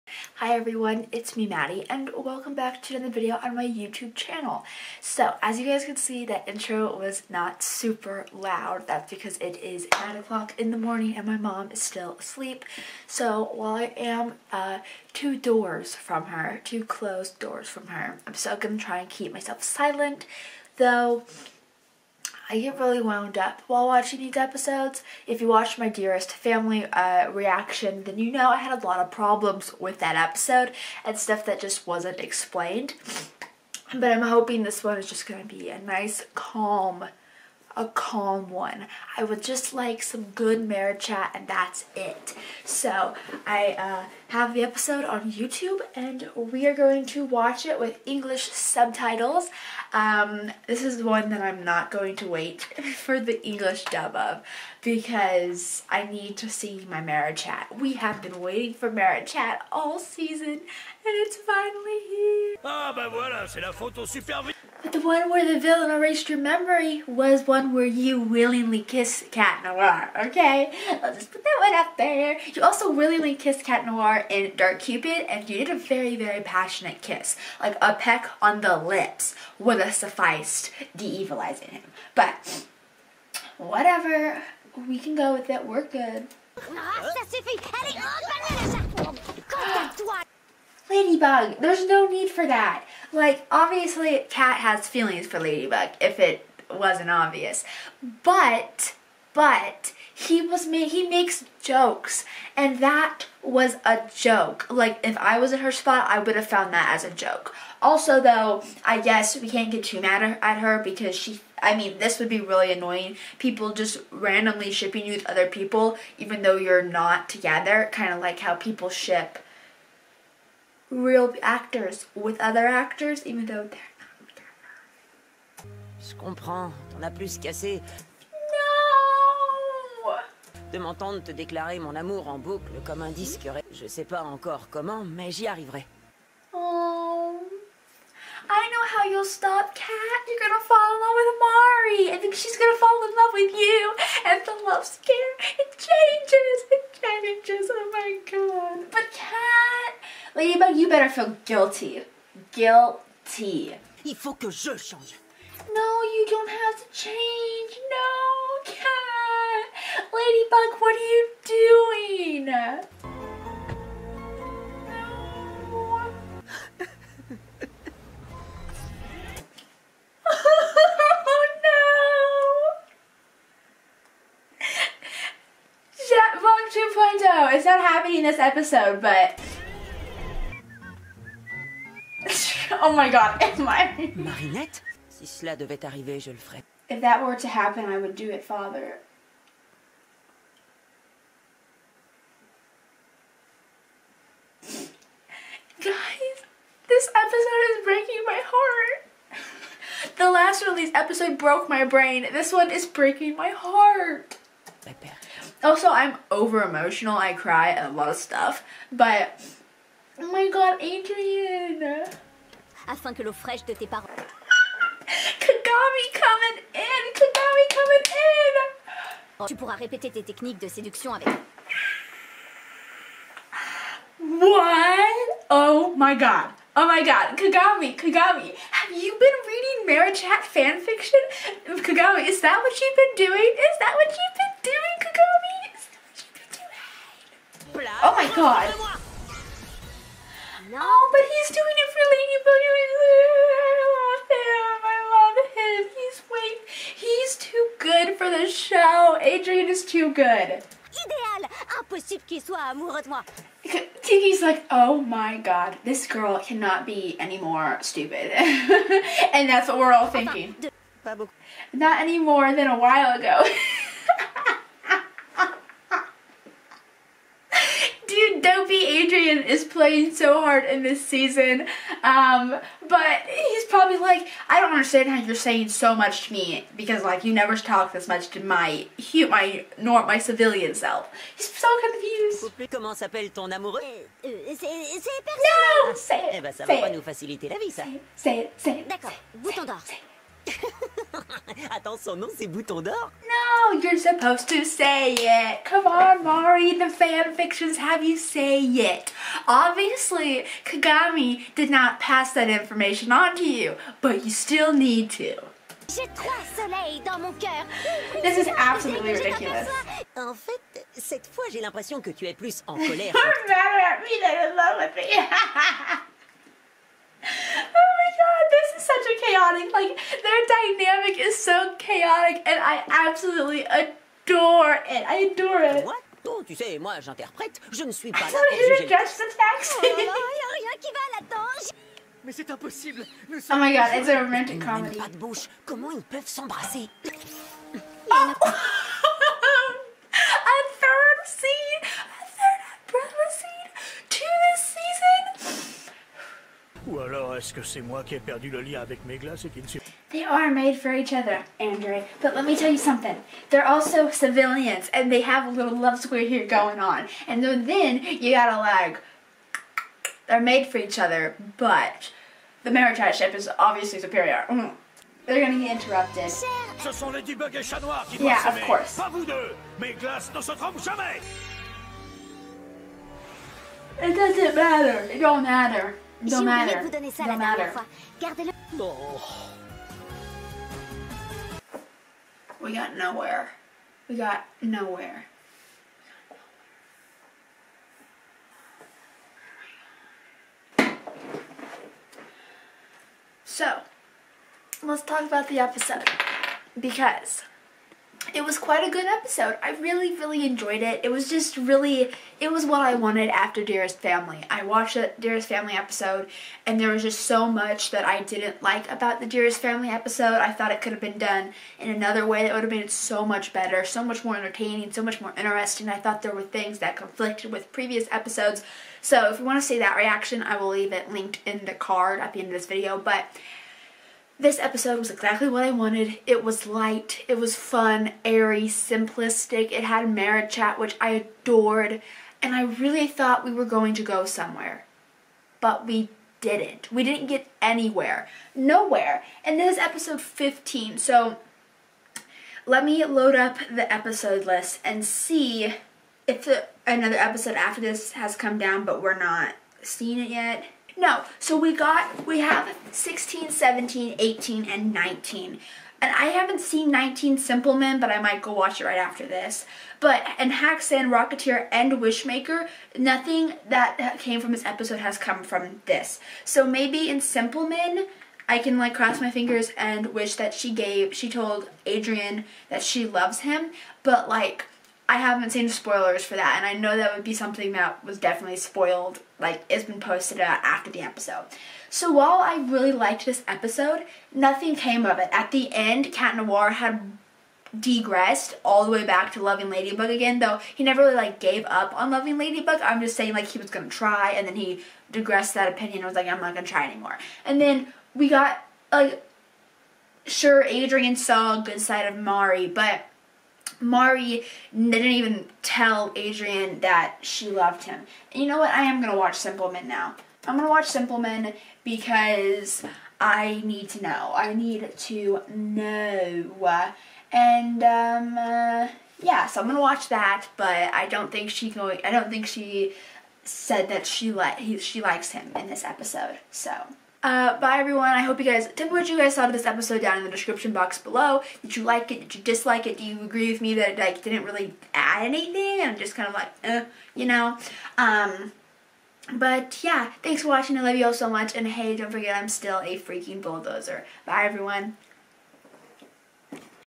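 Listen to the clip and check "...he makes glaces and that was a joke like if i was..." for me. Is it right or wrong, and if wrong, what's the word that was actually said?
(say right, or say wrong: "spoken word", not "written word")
wrong: "jokes", not "glaces".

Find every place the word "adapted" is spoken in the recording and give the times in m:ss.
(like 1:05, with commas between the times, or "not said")
not said.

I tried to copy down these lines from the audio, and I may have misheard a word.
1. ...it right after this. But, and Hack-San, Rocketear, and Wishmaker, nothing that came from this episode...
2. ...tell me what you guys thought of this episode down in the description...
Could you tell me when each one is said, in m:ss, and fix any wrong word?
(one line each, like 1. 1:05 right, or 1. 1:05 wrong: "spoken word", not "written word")
1. 7:38 right
2. 8:48 right.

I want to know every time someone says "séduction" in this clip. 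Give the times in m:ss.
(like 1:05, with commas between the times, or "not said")
3:40.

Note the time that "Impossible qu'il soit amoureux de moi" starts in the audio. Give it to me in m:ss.
4:11.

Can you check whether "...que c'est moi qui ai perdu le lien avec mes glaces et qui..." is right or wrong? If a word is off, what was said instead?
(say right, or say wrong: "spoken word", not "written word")
right.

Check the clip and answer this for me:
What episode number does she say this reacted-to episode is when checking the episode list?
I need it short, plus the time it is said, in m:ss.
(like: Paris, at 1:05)
15, at 7:19.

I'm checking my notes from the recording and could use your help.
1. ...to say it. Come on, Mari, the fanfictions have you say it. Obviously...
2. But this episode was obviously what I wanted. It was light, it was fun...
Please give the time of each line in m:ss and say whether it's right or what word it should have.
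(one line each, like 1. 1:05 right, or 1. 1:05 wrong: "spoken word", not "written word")
1. 4:54 right
2. 7:02 wrong: "exactly", not "obviously".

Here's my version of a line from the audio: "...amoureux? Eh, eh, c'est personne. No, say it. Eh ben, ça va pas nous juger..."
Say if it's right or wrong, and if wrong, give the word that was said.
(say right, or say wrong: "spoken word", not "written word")
wrong: "faciliter", not "juger".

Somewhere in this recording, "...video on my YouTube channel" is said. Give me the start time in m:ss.
0:03.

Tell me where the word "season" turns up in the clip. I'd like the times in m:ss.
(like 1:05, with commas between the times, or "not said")
0:59, 4:31.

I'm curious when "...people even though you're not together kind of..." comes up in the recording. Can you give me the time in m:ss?
1:55.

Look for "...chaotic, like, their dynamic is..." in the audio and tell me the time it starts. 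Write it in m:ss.
5:19.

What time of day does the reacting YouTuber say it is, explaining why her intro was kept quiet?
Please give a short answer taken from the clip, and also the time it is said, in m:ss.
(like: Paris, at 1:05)
9 o'clock, at 0:10.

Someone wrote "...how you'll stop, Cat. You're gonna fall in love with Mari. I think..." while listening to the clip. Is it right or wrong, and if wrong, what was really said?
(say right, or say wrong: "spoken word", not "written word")
right.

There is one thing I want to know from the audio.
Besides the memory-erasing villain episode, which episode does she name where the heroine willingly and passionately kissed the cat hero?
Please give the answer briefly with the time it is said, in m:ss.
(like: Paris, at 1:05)
Dark Cupid, at 1:14.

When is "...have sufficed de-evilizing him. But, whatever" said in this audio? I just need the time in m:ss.
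1:19.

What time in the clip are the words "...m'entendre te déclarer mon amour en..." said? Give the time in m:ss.
2:10.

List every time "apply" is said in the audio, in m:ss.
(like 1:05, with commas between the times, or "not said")
not said.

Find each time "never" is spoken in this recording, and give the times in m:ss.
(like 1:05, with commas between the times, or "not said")
4:37, 8:10.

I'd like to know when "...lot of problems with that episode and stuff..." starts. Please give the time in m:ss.
0:28.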